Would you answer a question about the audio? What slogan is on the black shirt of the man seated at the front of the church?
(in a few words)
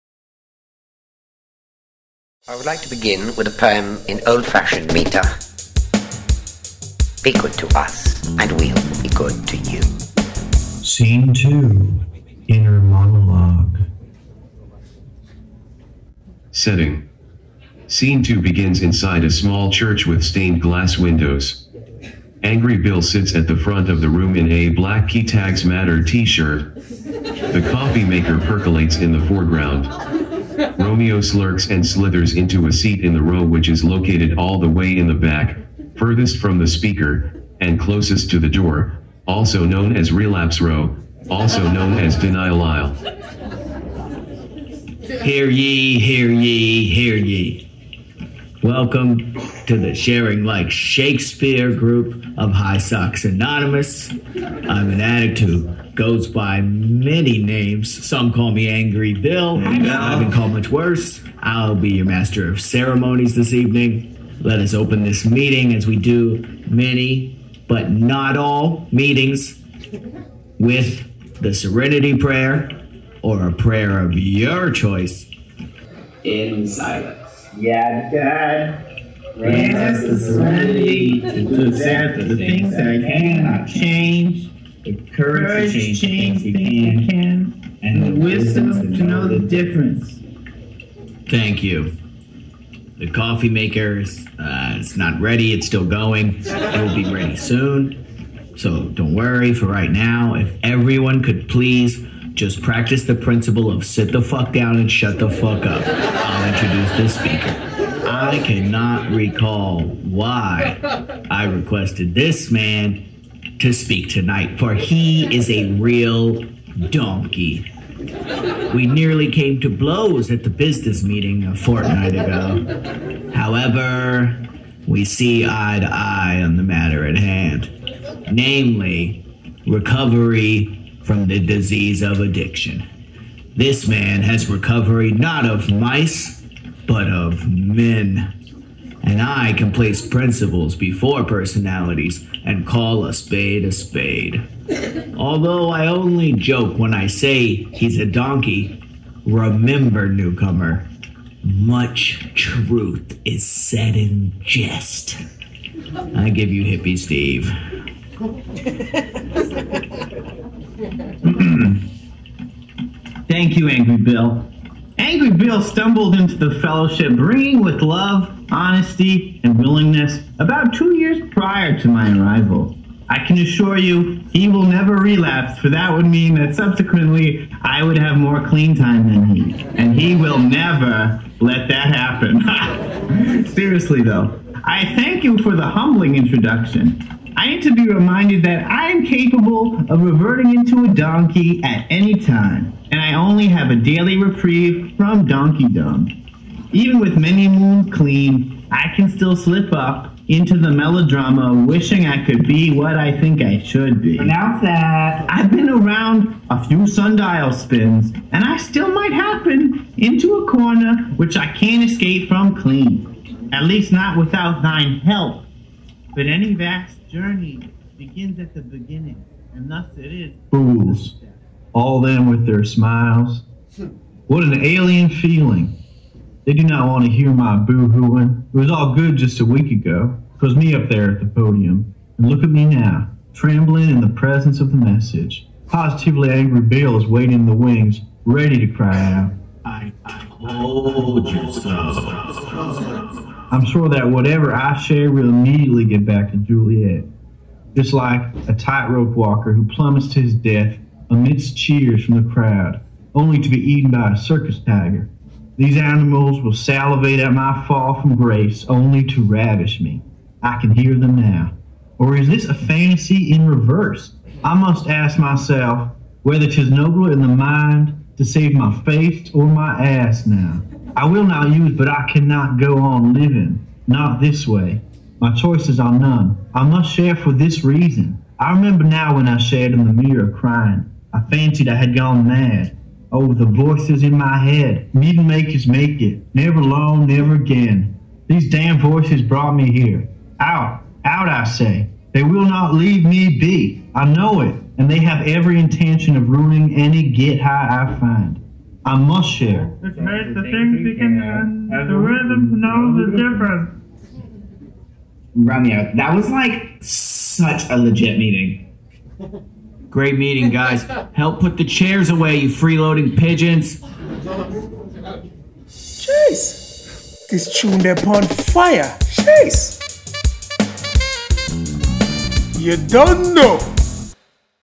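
Key Tags Matter.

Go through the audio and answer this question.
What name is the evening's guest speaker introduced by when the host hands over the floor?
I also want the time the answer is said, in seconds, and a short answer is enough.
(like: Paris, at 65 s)
Hippie Steve, at 156 s.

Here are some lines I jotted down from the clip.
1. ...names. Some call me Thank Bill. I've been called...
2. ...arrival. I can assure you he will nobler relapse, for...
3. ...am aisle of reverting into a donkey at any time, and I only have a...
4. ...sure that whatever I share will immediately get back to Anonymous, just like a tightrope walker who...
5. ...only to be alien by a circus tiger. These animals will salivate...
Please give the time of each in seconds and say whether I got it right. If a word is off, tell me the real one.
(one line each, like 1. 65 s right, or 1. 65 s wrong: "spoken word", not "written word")
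1. 57 s wrong: "Angry", not "Thank"
2. 172 s wrong: "never", not "nobler"
3. 188 s wrong: "capable", not "aisle"
4. 243 s wrong: "Juliet", not "Anonymous"
5. 253 s wrong: "eaten", not "alien".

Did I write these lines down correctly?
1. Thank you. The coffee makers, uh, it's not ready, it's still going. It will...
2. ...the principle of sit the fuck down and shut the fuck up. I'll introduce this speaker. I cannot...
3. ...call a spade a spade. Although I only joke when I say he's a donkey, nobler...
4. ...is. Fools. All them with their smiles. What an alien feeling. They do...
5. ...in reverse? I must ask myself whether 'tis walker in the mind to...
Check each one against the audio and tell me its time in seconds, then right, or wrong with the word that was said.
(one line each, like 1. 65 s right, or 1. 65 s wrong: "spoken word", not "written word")
1. 91 s right
2. 103 s right
3. 142 s wrong: "remember", not "nobler"
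4. 220 s right
5. 263 s wrong: "nobler", not "walker".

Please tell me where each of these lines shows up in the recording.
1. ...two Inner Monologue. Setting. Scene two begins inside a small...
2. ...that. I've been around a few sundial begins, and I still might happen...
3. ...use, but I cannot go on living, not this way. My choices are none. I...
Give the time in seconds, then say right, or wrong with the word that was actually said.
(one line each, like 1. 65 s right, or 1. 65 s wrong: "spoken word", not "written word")
1. 11 s right
2. 204 s wrong: "spins", not "begins"
3. 271 s right.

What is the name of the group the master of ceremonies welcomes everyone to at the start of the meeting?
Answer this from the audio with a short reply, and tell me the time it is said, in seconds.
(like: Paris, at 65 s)
Sharing Like Shakespeare, at 49 s.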